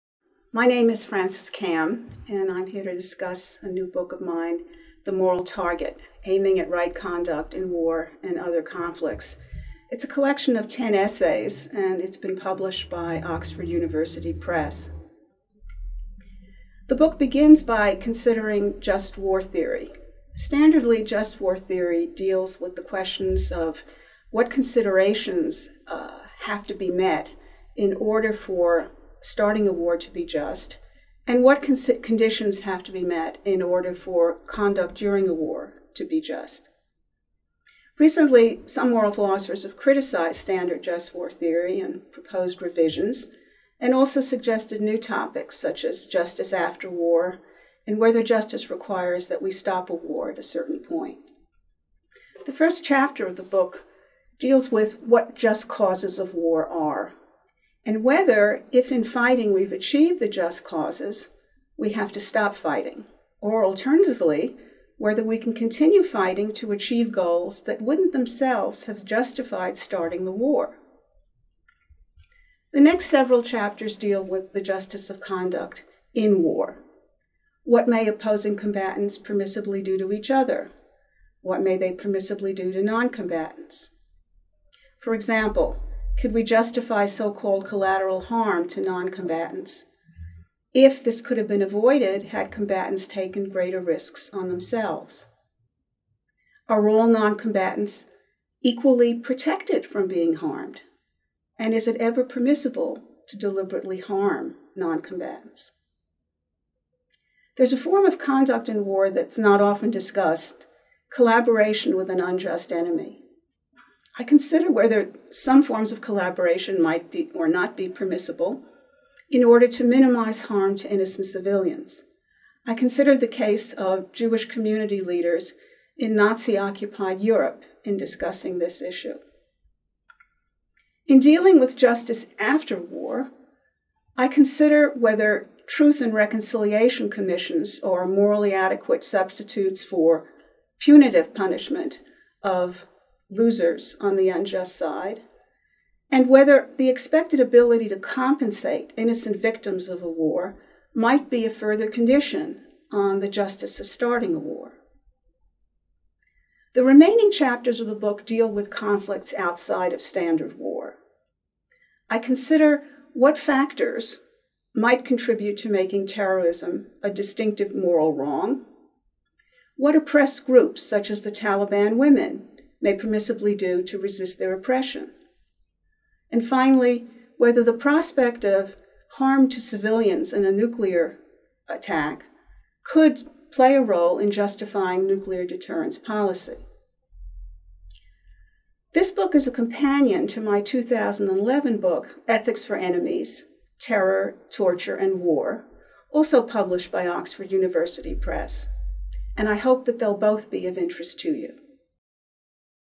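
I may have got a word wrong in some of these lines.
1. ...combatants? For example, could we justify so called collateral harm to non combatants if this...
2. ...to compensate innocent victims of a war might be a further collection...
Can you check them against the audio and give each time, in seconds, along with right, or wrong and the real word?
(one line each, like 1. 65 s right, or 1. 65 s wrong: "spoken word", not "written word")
1. 83 s right
2. 147 s wrong: "condition", not "collection".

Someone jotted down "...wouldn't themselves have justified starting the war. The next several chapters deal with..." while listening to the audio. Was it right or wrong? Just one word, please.
right.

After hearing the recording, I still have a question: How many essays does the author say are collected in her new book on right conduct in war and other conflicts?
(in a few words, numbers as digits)
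10.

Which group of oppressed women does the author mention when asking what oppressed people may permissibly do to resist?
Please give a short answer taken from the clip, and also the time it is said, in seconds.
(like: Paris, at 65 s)
Taliban women, at 171 s.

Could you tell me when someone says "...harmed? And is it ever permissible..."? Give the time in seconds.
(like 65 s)
100 s.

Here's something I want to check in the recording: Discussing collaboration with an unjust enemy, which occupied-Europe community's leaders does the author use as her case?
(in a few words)
Jewish community leaders.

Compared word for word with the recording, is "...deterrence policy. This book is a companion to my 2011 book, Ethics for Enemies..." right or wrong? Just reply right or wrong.
right.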